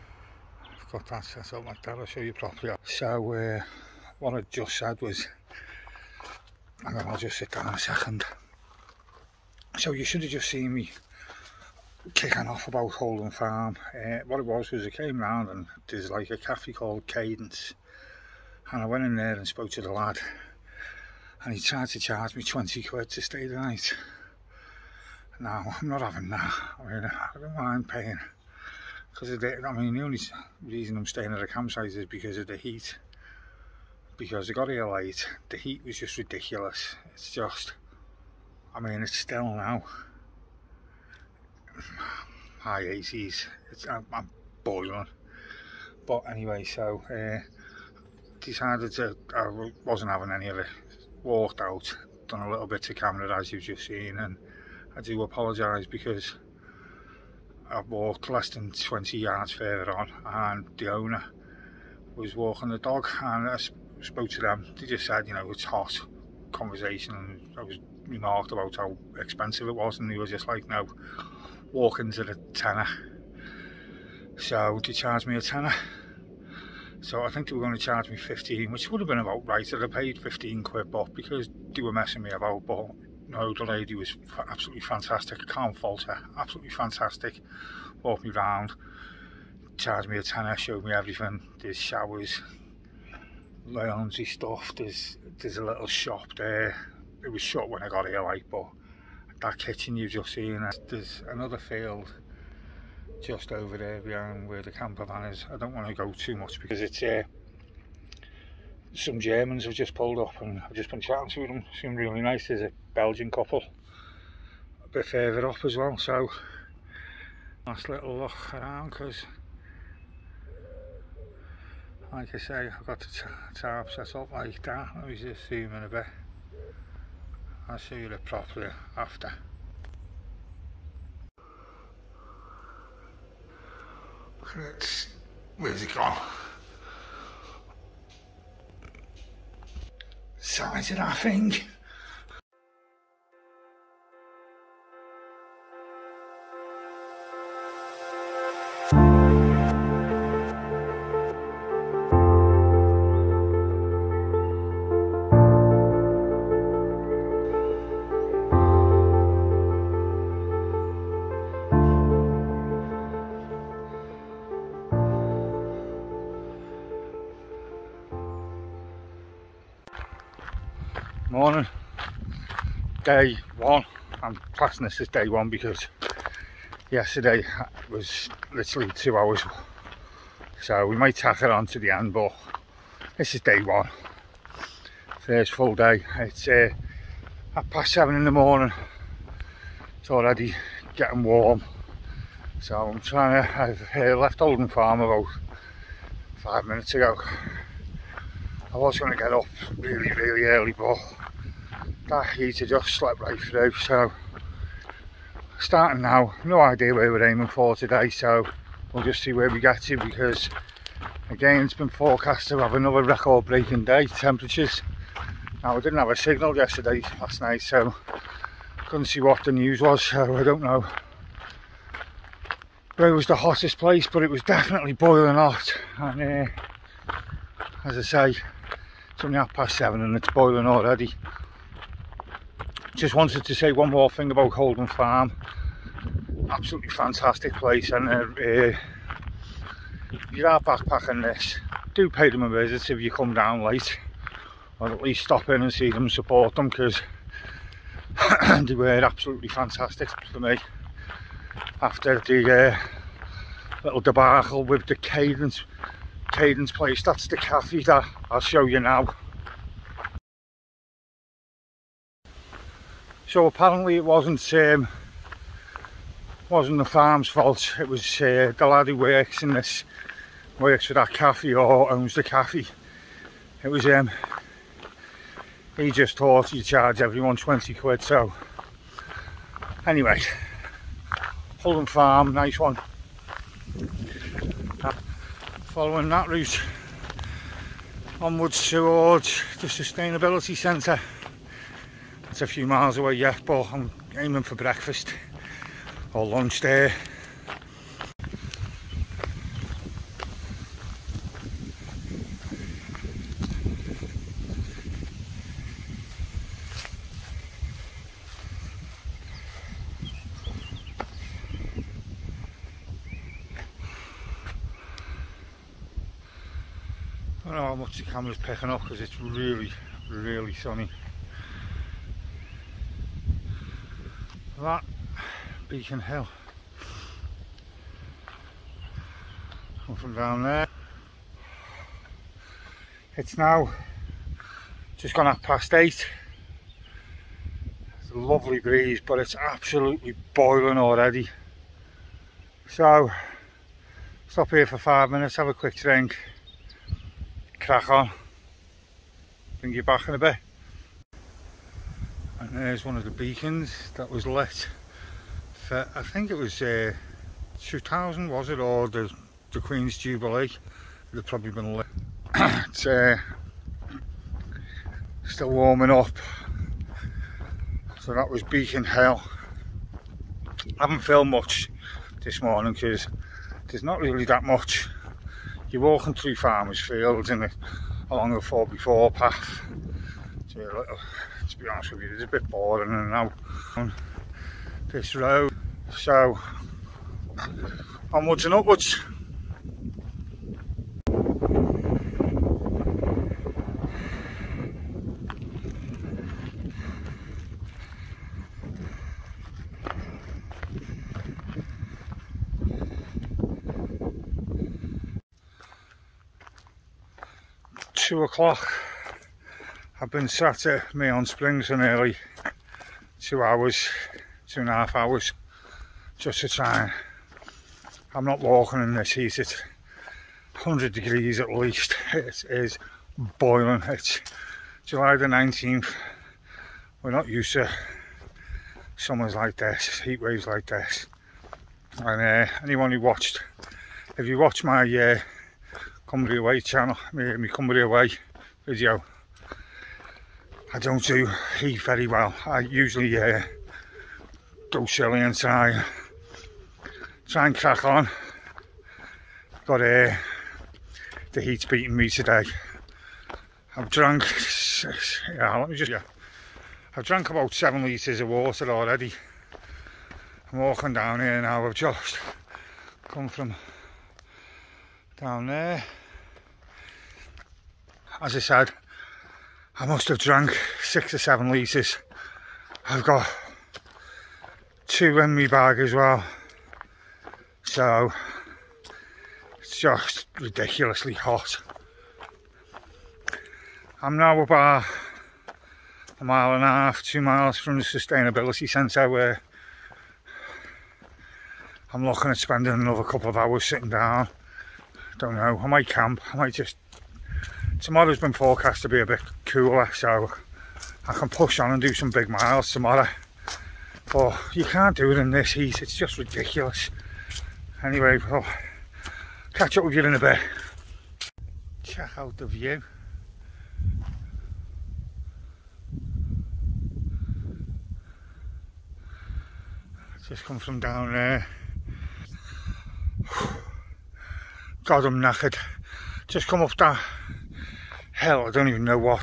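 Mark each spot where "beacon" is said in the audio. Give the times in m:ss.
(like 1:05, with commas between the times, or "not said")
5:25, 5:53, 6:08.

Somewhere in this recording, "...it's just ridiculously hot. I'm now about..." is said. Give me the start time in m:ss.
7:59.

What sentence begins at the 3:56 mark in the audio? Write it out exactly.
Absolutely fantastic place, and uh, uh, you are backpacking this.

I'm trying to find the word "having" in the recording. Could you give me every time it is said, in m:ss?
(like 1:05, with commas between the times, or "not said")
0:26, 0:50.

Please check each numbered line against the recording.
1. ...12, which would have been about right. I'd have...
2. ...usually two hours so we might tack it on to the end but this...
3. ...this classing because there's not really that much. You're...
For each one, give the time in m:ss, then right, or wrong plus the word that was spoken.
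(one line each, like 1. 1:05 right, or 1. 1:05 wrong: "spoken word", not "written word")
1. 1:18 wrong: "15", not "12"
2. 2:58 wrong: "literally", not "usually"
3. 6:12 wrong: "morning", not "classing".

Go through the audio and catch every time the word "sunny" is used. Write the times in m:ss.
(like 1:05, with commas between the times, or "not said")
5:20.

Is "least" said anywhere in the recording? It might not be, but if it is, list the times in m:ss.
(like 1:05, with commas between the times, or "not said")
4:05, 7:01.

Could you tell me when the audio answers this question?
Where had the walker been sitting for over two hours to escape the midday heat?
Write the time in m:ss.
6:50.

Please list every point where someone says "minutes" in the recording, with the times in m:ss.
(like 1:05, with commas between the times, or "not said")
3:16, 5:45.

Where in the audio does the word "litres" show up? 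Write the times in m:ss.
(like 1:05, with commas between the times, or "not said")
7:37, 7:51.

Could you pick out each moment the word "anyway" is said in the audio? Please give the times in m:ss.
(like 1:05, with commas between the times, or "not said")
0:46, 4:39, 8:27.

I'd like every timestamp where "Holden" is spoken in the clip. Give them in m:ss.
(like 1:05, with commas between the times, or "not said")
0:12, 3:14, 3:54, 4:41.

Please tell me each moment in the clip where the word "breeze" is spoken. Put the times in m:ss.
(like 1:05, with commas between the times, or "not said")
5:38.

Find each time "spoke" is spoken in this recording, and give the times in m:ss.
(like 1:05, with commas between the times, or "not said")
0:19, 1:04.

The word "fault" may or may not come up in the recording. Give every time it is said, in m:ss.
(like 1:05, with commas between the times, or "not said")
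1:25, 4:27.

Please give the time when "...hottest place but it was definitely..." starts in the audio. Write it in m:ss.
3:43.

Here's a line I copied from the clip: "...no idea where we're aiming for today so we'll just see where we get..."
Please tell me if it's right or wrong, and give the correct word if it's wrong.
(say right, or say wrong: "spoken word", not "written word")
right.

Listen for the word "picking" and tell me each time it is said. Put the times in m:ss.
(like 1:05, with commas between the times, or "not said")
5:18.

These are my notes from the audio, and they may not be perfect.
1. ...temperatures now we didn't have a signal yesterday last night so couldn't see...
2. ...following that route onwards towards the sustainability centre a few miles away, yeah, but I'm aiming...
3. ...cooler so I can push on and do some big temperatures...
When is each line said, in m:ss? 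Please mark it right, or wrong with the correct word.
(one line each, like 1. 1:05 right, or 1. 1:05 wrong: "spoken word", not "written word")
1. 3:34 right
2. 4:45 right
3. 8:19 wrong: "miles", not "temperatures".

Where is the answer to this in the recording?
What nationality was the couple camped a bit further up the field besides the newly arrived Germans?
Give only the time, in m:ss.
1:52.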